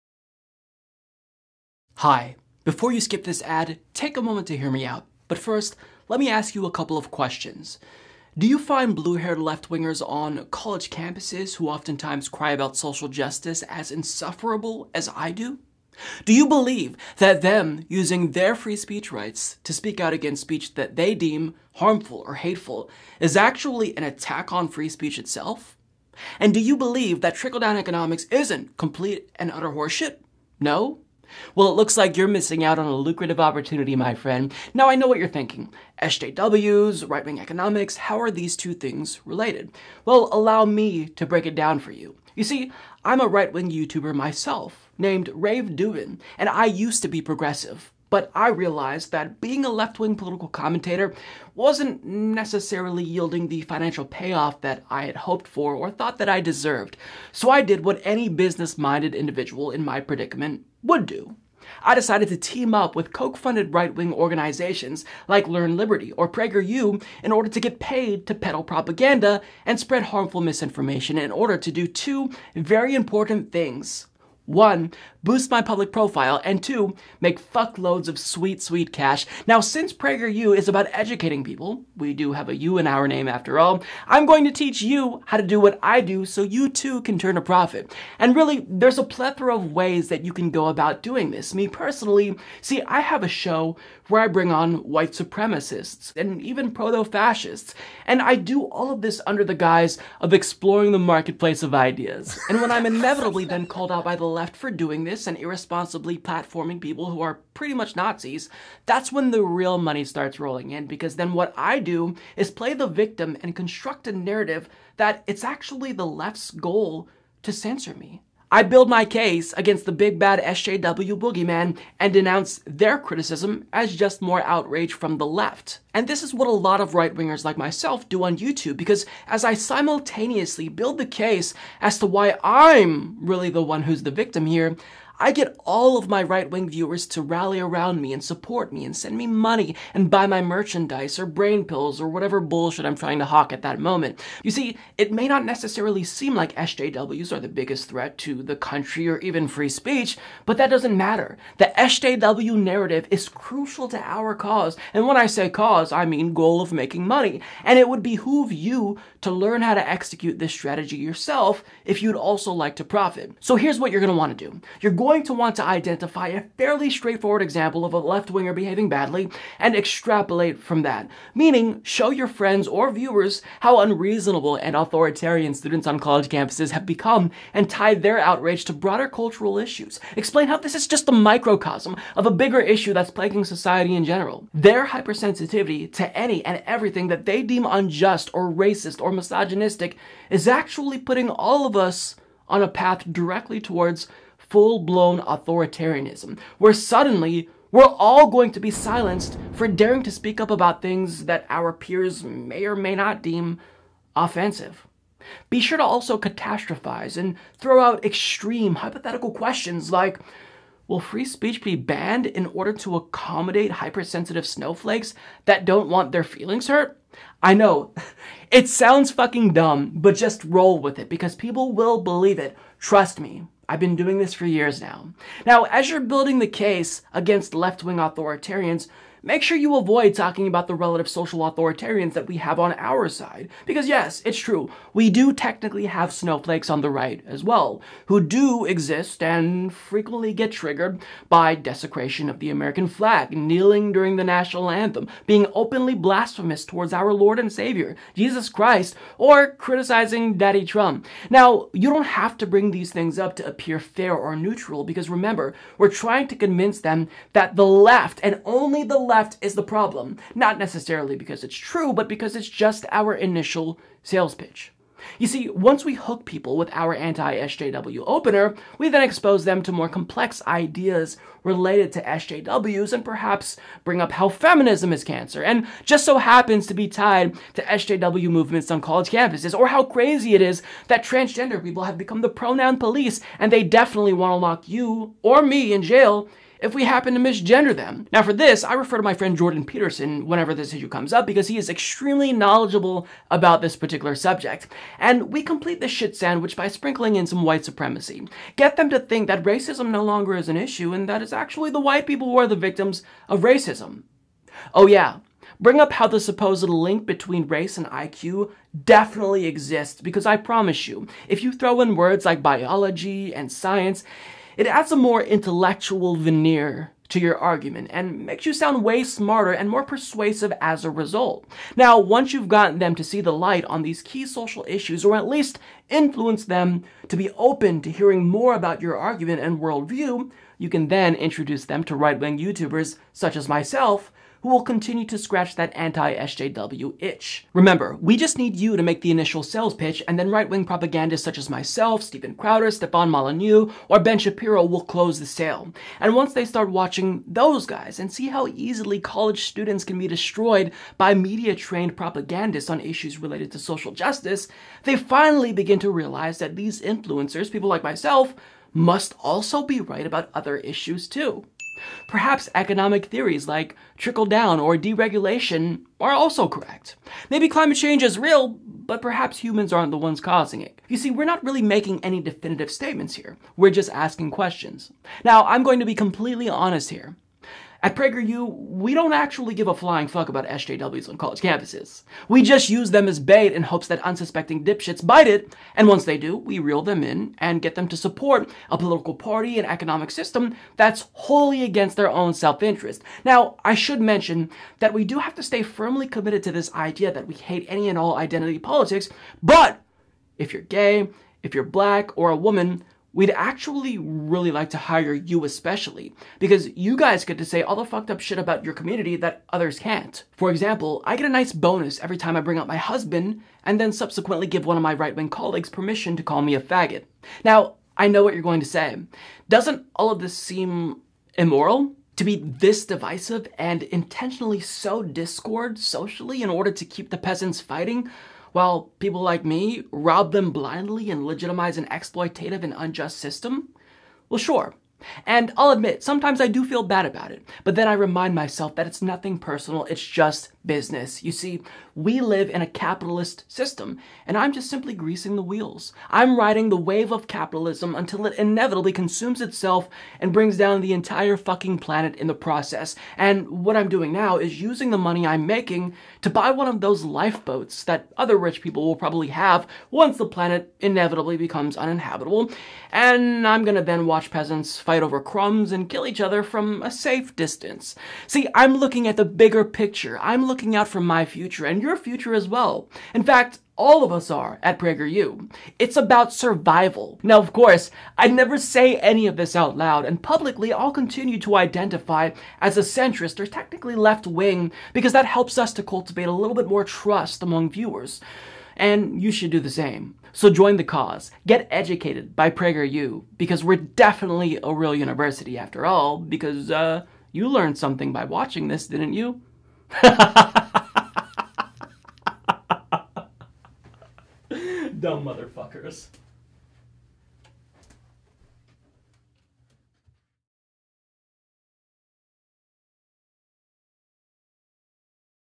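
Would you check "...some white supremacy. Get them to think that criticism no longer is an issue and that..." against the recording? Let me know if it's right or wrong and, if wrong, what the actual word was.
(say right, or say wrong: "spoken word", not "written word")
wrong: "racism", not "criticism".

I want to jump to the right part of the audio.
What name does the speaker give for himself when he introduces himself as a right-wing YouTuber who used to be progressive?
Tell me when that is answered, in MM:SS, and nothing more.
00:45.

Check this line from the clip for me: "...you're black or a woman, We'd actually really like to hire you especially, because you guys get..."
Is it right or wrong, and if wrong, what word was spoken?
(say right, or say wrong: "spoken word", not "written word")
right.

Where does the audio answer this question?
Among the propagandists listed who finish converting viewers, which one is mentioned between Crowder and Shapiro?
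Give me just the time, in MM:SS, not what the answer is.
05:42.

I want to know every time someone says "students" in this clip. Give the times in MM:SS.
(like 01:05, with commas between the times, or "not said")
02:55, 05:49.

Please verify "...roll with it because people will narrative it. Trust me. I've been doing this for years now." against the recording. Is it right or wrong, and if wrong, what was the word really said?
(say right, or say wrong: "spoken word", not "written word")
wrong: "believe", not "narrative".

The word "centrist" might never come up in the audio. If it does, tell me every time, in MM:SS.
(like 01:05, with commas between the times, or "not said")
08:02.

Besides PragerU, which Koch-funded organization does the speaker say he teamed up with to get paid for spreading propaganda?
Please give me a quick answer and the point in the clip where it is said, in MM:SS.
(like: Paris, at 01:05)
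Learn Liberty, at 01:05.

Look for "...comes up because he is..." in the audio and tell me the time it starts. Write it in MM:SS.
04:50.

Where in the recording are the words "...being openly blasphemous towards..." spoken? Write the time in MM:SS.
04:05.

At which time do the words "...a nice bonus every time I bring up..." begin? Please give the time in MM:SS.
06:51.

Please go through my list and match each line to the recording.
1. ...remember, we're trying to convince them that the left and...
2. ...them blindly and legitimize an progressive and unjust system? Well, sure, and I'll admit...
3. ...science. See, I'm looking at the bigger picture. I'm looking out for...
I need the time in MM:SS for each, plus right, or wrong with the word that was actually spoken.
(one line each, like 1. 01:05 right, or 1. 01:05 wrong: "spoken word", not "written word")
1. 04:15 right
2. 07:10 wrong: "exploitative", not "progressive"
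3. 07:47 wrong: "distance", not "science".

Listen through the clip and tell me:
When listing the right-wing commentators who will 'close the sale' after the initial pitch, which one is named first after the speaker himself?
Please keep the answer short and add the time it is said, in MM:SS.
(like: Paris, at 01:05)
Steven Crowder, at 05:42.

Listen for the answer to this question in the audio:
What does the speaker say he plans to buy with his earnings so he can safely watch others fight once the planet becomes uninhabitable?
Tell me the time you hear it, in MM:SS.
07:37.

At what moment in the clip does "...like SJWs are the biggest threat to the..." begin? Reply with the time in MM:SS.
02:26.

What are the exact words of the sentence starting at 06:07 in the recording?
Maybe climate change is real, but perhaps humans aren't the ones causing it.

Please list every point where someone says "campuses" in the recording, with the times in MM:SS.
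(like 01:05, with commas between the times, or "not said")
00:10, 02:56, 04:39, 06:21.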